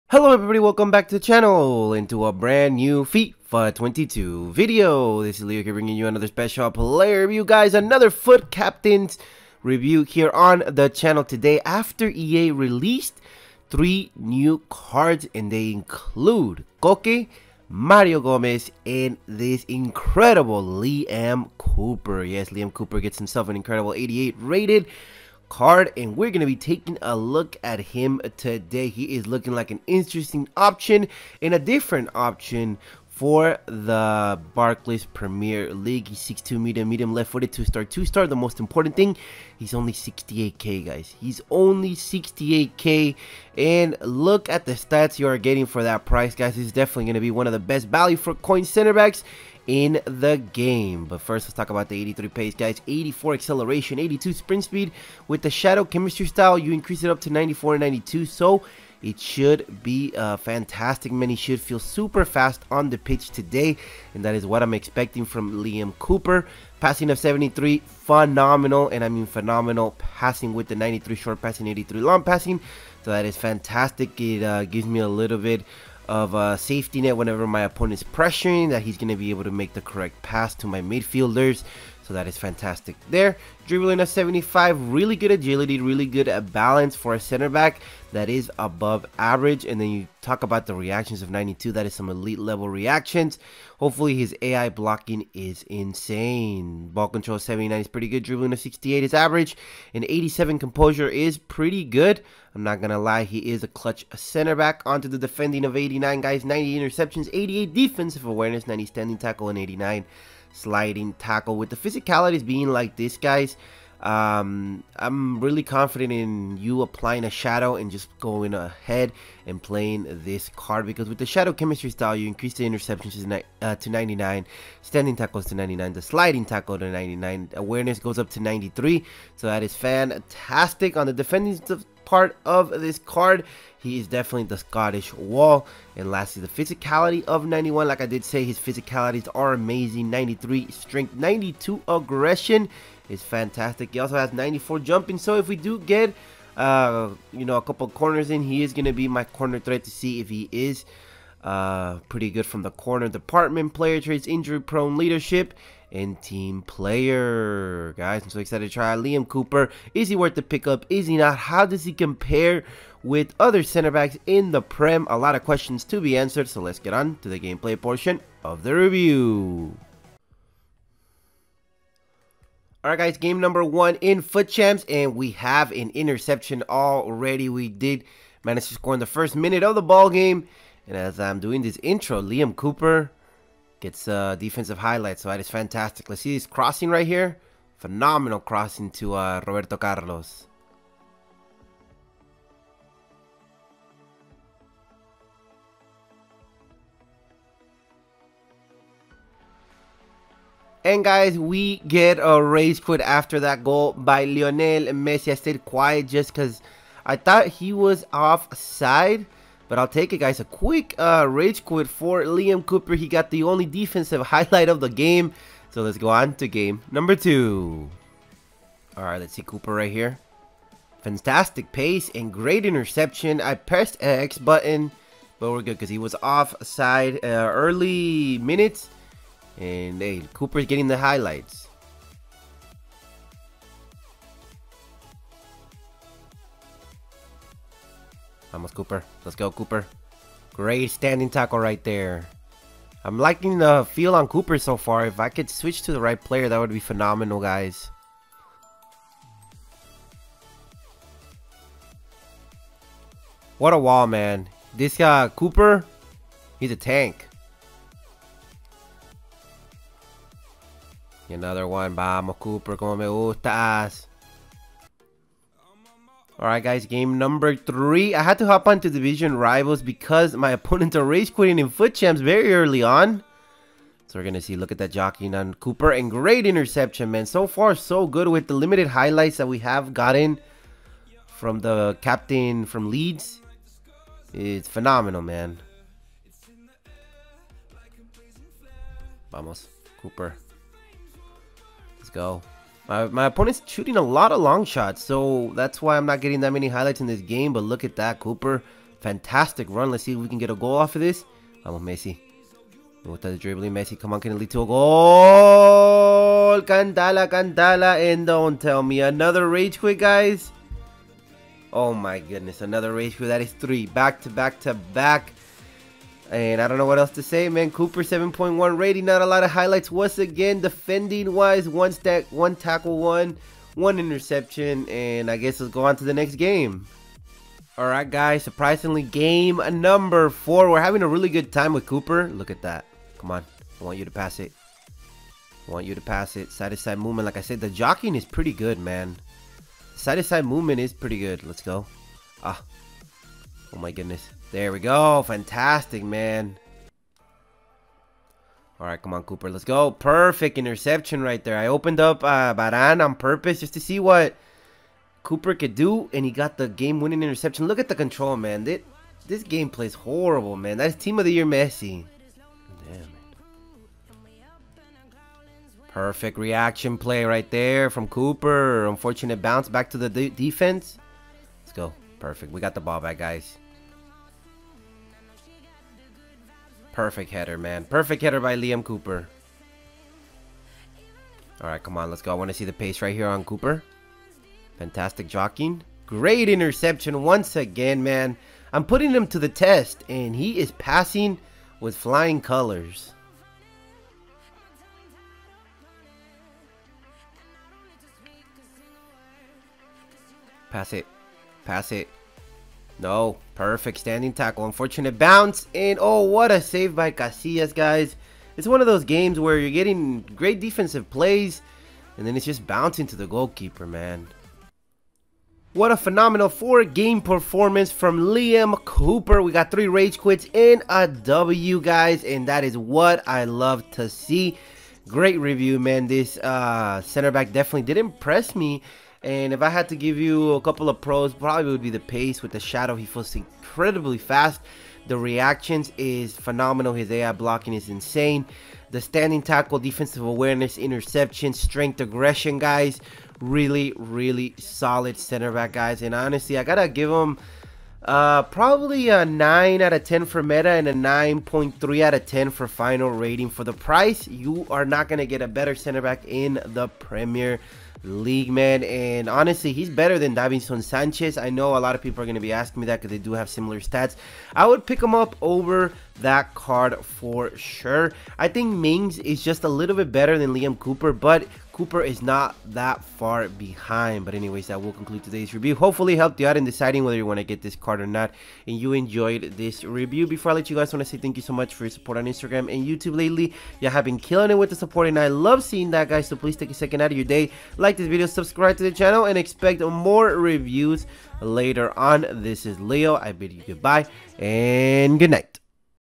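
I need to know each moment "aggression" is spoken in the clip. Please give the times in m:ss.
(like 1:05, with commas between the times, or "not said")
2:21, 7:22.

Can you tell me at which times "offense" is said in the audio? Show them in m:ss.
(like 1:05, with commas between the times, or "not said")
not said.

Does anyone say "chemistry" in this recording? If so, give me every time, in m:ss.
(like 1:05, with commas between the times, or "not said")
0:55, 2:01.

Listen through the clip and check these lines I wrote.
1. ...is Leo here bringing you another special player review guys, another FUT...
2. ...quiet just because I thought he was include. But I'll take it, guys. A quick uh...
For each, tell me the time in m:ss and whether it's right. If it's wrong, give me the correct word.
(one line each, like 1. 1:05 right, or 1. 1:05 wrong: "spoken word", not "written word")
1. 0:05 right
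2. 3:25 wrong: "offside", not "include".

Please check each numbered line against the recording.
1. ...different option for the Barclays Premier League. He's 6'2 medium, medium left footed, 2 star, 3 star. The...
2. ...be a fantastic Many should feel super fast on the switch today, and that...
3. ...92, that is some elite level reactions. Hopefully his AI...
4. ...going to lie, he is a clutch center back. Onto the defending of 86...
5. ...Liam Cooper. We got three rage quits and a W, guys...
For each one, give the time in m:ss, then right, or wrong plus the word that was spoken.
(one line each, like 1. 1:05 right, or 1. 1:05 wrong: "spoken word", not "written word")
1. 0:31 wrong: "2", not "3"
2. 0:59 wrong: "pitch", not "switch"
3. 1:31 right
4. 1:42 wrong: "89", not "86"
5. 6:58 right.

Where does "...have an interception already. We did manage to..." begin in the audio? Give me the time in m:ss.
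2:55.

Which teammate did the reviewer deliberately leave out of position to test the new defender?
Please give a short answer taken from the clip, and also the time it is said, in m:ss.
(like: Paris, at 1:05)
Varane, at 5:52.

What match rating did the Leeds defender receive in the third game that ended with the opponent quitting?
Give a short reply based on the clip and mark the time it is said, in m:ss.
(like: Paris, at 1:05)
7.1, at 5:18.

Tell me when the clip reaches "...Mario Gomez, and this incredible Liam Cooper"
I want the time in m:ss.
0:17.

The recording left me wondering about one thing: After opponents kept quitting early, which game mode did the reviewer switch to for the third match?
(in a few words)
Division Rivals.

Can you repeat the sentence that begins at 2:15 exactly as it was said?
And lastly, the physicality of 91.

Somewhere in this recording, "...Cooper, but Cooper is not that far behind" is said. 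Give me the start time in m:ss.
7:50.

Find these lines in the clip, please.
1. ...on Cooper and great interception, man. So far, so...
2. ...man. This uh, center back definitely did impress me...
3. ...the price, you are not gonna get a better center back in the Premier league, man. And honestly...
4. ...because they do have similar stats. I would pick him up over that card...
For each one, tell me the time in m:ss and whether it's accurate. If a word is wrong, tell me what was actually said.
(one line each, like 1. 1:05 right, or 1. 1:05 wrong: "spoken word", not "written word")
1. 4:35 right
2. 7:05 right
3. 7:33 right
4. 7:43 right.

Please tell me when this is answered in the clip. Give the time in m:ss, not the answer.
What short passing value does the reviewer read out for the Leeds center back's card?
1:10.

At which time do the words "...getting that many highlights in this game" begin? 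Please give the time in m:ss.
4:56.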